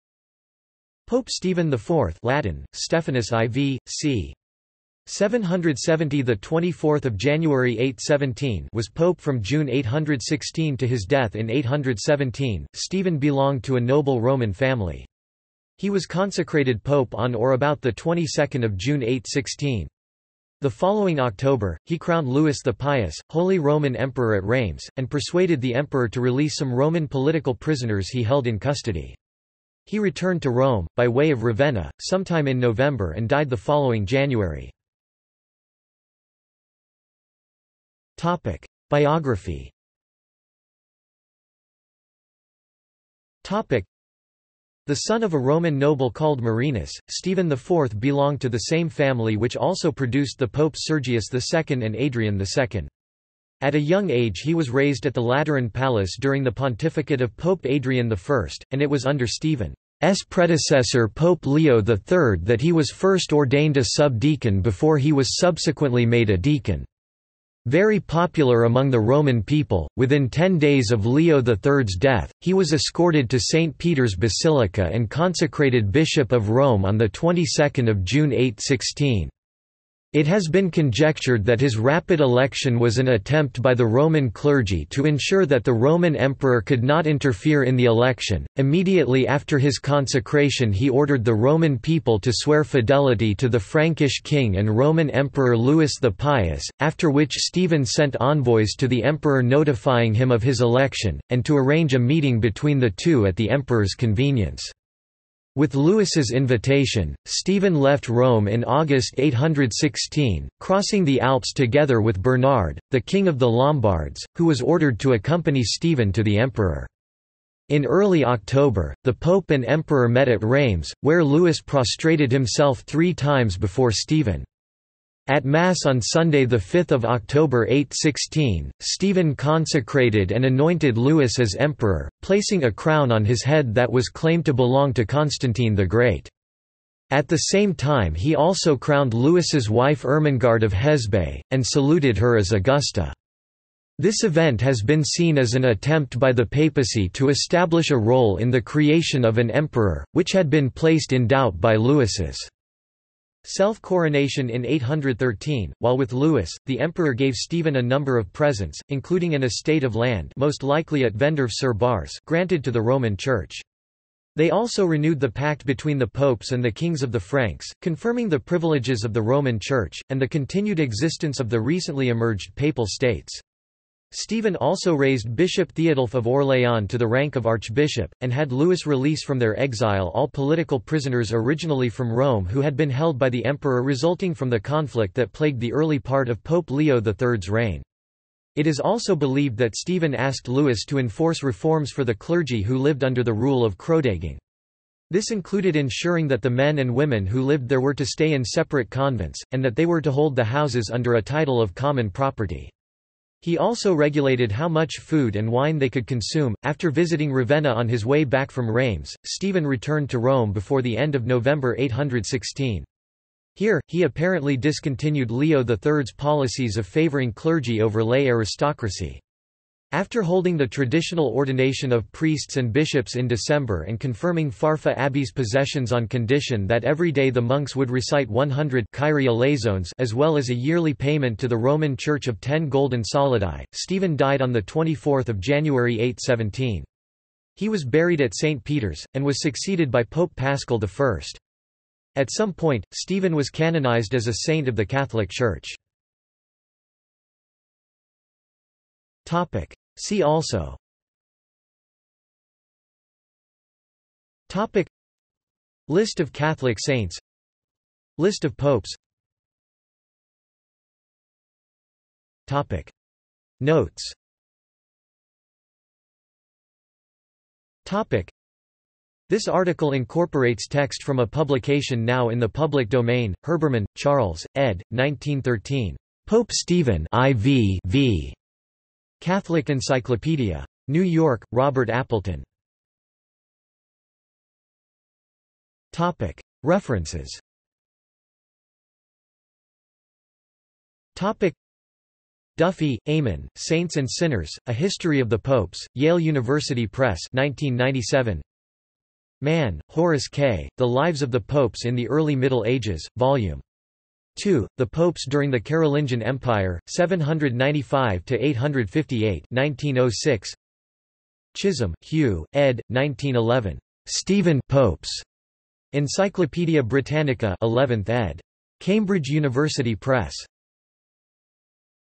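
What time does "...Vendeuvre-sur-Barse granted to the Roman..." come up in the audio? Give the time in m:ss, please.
2:41.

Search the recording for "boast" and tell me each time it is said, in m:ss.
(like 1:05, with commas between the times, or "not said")
not said.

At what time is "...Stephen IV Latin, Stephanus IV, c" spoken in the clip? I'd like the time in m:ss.
0:01.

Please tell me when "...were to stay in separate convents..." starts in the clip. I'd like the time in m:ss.
3:17.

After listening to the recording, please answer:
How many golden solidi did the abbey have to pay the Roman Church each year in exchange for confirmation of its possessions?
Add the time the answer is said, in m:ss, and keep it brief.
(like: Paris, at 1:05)
10, at 3:52.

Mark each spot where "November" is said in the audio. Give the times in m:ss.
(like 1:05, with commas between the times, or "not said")
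0:32, 3:31.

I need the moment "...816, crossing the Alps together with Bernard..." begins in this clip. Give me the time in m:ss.
1:49.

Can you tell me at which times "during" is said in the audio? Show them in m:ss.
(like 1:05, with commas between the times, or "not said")
0:56, 5:05.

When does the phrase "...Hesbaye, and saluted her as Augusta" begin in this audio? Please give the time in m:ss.
2:20.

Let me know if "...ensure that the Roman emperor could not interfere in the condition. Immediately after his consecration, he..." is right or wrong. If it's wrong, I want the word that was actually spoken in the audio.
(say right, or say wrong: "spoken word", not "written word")
wrong: "election", not "condition".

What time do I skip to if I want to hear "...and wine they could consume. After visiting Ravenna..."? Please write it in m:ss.
3:25.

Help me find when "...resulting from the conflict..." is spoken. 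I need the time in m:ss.
3:03.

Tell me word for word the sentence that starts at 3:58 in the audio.
Peter's, and was succeeded by Pope Paschal I.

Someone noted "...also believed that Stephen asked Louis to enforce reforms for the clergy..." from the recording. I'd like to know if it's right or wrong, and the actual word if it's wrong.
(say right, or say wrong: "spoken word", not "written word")
right.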